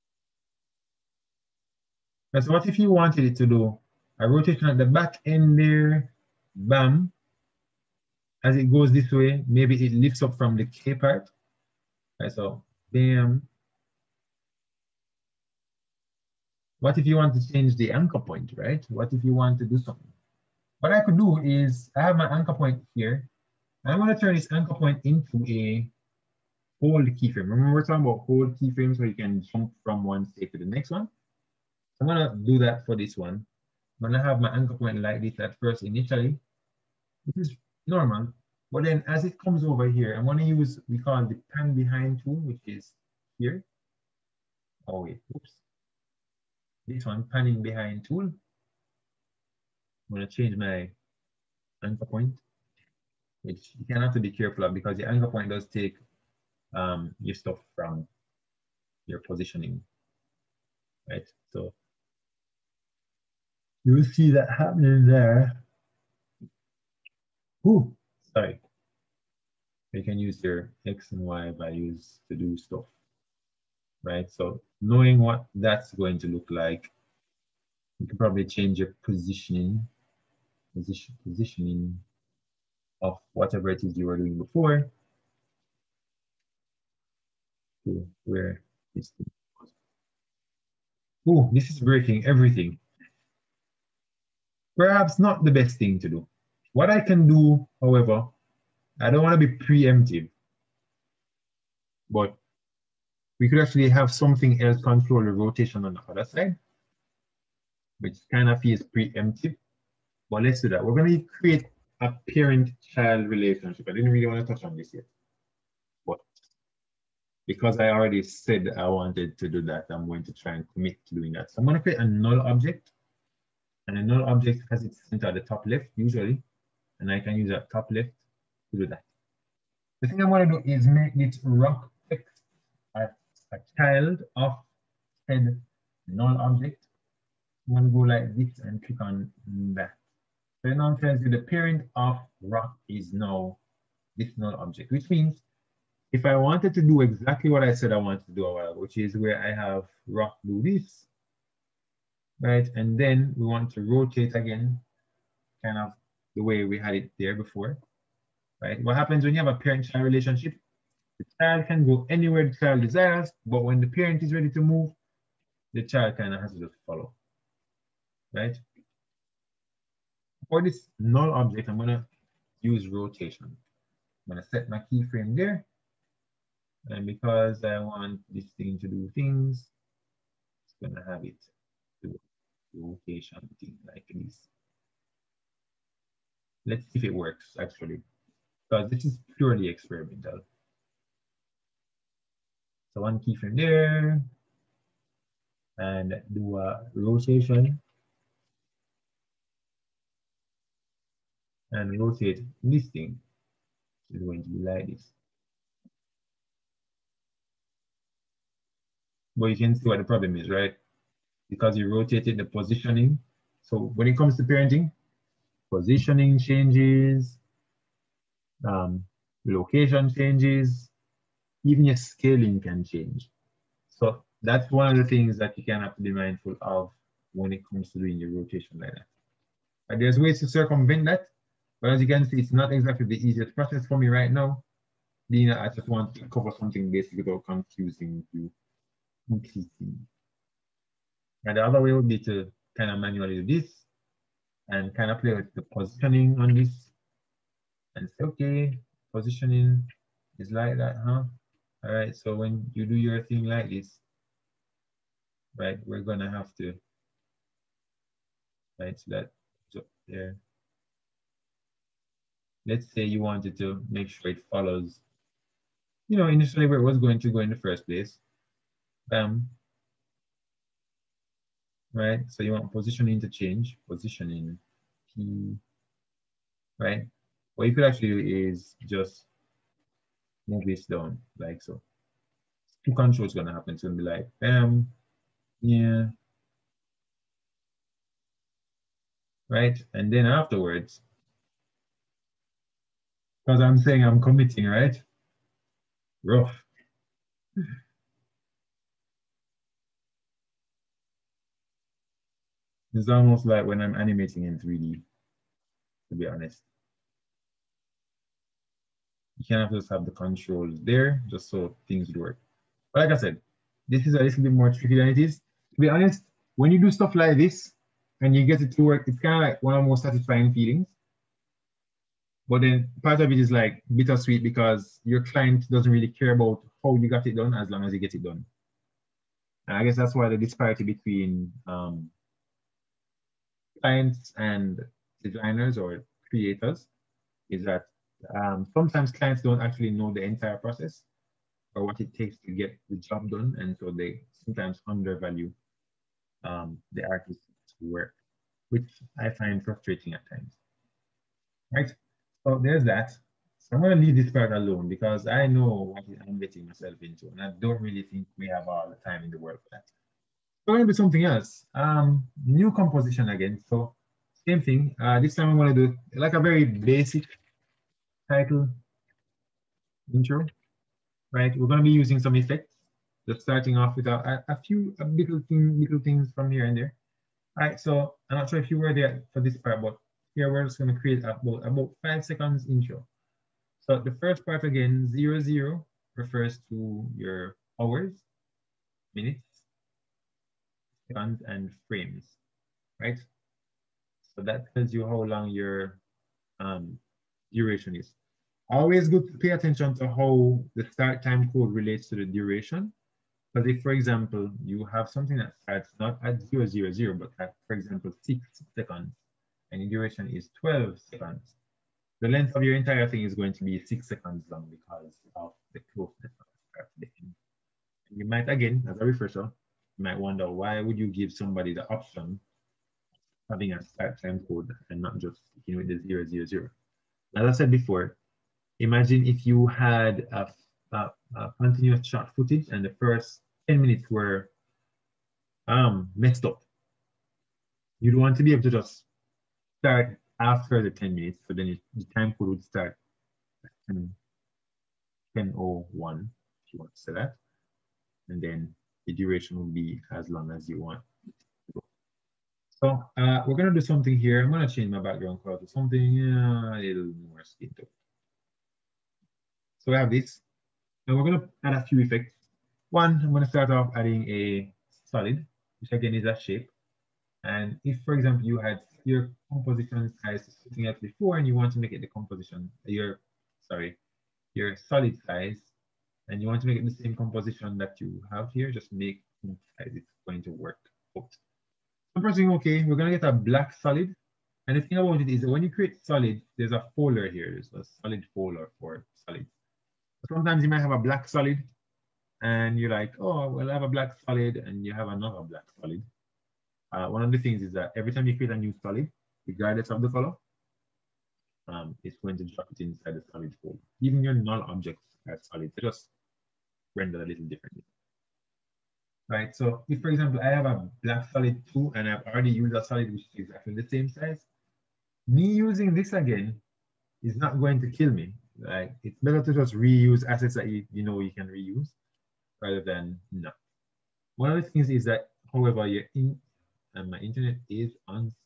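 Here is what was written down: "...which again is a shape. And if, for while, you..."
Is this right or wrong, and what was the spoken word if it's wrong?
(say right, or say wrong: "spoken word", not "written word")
wrong: "example", not "while".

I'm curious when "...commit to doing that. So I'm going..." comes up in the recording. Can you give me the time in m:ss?
2:00.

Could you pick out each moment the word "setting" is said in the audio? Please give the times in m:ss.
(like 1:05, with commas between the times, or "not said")
not said.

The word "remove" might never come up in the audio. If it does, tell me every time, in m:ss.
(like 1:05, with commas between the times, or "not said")
not said.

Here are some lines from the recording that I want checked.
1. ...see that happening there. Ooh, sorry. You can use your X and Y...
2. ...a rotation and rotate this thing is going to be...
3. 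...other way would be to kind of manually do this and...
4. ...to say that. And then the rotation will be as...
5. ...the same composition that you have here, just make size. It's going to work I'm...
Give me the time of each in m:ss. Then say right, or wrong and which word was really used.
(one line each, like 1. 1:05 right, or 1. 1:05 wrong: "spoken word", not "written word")
1. 1:04 right
2. 3:16 right
3. 4:01 right
4. 7:26 wrong: "duration", not "rotation"
5. 7:56 right.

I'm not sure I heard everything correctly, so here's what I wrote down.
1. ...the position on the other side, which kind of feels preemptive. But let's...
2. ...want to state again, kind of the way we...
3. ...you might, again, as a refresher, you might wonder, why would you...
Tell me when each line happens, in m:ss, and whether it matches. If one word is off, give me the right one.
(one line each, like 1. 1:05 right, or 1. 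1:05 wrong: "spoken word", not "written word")
1. 1:45 wrong: "rotation", not "position"
2. 2:33 wrong: "rotate", not "state"
3. 6:58 right.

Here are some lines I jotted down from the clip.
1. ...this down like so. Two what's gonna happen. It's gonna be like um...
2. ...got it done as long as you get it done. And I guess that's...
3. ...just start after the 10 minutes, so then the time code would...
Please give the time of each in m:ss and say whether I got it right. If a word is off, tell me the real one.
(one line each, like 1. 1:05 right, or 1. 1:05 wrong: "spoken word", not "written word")
1. 4:40 right
2. 5:27 right
3. 7:18 right.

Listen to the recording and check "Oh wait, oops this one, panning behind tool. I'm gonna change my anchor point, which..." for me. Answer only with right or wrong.
right.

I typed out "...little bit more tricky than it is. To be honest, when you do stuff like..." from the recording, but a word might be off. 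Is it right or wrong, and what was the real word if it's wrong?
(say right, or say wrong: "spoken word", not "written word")
right.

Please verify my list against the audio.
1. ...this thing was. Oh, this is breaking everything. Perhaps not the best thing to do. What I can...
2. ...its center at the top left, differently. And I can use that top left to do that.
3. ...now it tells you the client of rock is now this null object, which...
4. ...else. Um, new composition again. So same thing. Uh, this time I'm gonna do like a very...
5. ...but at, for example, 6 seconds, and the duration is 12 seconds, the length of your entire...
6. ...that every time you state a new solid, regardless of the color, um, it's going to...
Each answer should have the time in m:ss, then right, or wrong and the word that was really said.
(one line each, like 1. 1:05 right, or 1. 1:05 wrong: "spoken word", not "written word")
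1. 1:28 right
2. 2:04 wrong: "usually", not "differently"
3. 2:20 wrong: "parent", not "client"
4. 6:01 right
5. 6:47 right
6. 8:17 wrong: "create", not "state".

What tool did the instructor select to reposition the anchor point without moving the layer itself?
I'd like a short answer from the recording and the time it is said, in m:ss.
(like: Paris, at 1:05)
Pan behind tool, at 0:41.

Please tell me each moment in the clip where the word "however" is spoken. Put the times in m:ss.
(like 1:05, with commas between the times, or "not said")
1:37, 8:45.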